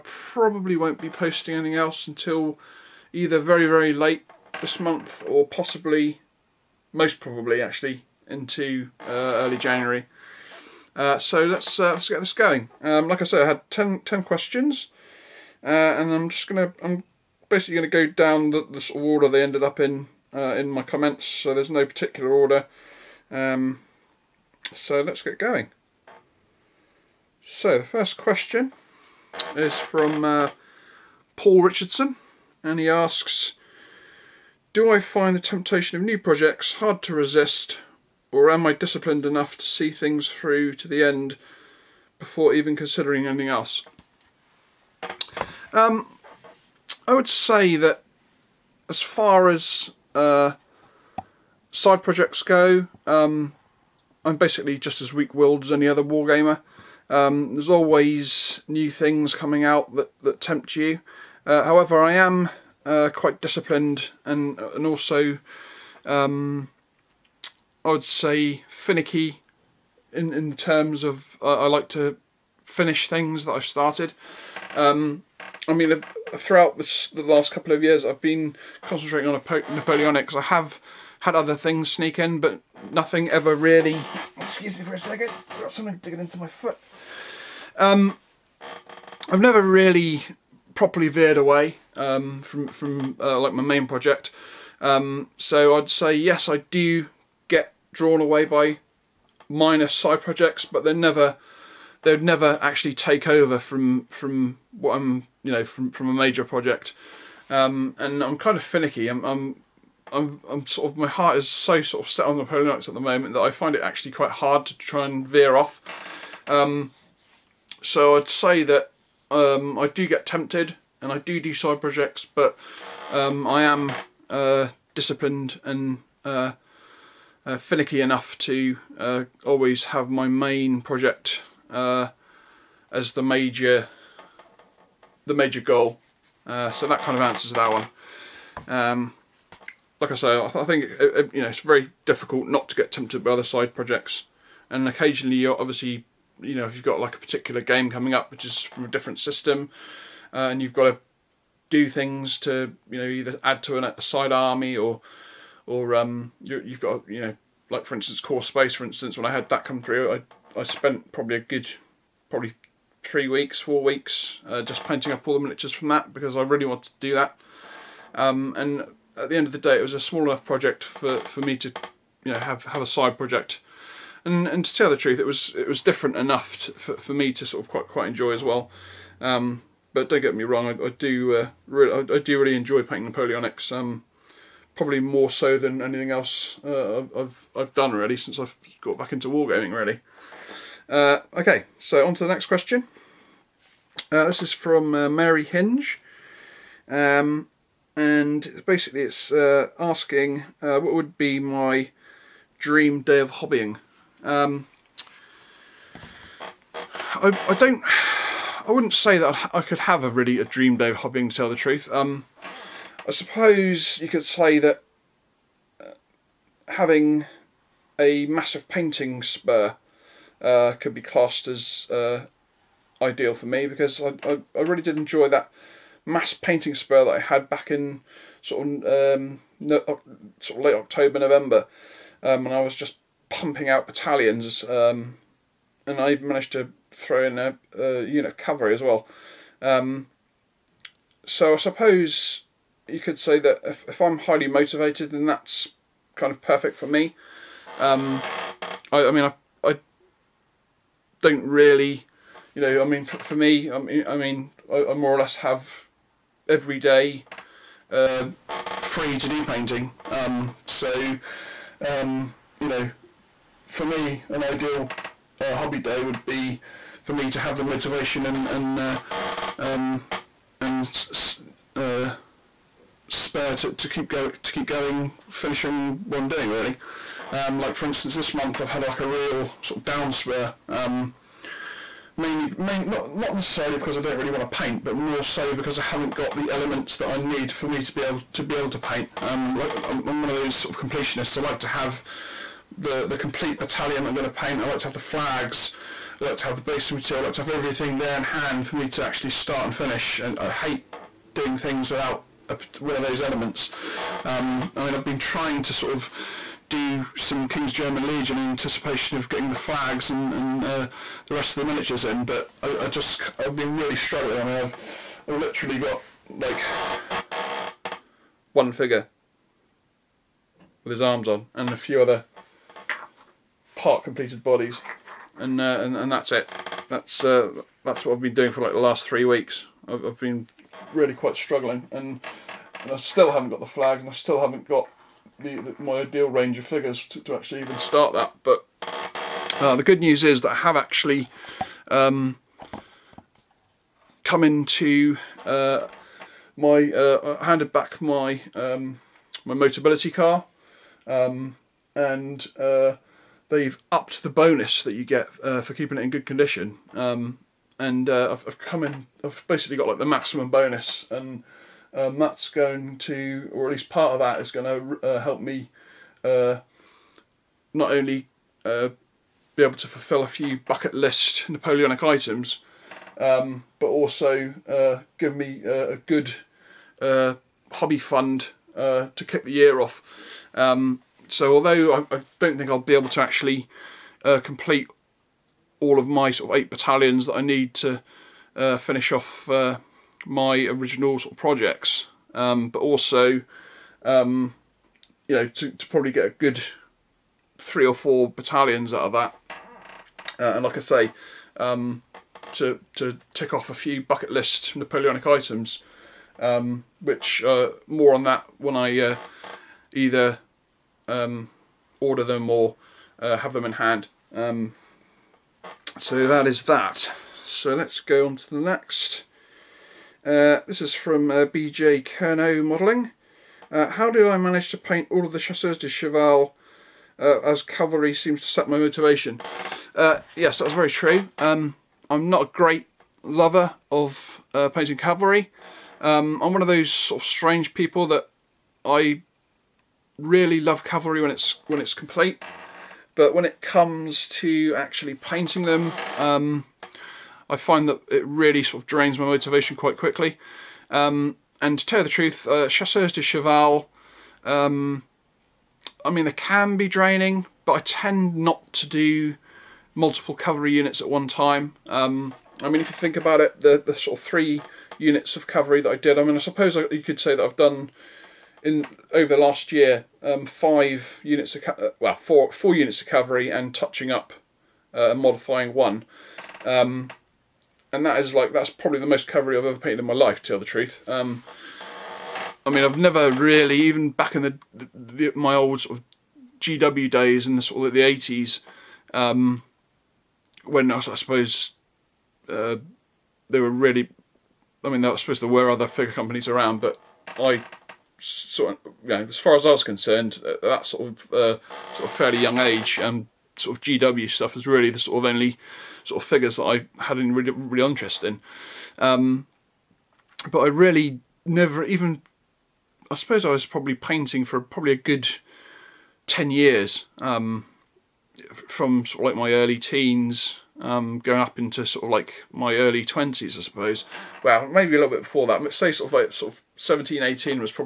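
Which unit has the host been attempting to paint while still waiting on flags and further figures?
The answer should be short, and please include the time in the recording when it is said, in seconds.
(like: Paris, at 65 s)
King's German Legion, at 307 s.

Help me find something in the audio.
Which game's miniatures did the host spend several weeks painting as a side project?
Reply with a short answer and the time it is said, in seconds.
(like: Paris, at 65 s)
Core Space, at 158 s.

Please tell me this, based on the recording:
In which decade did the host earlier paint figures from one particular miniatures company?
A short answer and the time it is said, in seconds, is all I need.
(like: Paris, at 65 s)
The eighties, at 488 s.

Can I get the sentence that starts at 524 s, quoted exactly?
Well, maybe a little bit before that.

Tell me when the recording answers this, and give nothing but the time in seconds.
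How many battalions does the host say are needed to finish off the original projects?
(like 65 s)
386 s.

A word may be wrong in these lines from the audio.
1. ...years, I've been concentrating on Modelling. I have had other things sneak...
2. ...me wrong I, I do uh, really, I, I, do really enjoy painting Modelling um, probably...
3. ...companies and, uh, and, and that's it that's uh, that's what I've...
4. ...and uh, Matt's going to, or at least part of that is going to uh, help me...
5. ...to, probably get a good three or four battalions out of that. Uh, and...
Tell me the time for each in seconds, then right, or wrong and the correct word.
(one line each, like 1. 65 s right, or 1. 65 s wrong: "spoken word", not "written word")
1. 77 s wrong: "Napoleonic", not "Modelling"
2. 180 s wrong: "Napoleonics", not "Modelling"
3. 324 s wrong: "bodies", not "companies"
4. 361 s right
5. 395 s right.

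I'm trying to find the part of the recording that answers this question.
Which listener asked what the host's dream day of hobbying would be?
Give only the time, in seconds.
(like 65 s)
195 s.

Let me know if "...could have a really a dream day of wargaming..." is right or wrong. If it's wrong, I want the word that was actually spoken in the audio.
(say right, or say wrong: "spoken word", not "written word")
wrong: "hobbying", not "wargaming".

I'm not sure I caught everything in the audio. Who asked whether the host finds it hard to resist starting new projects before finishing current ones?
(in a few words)
Paul Richardson.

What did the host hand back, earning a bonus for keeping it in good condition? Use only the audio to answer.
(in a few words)
Motability car.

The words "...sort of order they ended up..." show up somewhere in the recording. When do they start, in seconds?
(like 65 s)
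18 s.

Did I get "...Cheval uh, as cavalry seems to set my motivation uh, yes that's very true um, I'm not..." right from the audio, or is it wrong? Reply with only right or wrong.
right.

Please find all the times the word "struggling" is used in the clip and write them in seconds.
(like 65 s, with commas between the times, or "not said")
313 s, 331 s.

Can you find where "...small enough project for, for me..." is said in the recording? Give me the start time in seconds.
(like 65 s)
169 s.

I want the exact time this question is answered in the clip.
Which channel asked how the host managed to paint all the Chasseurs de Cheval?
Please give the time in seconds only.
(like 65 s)
421 s.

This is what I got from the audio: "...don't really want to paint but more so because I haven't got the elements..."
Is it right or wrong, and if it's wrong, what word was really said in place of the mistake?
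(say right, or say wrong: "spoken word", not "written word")
right.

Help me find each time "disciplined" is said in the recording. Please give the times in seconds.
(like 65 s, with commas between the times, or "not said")
38 s, 63 s, 124 s.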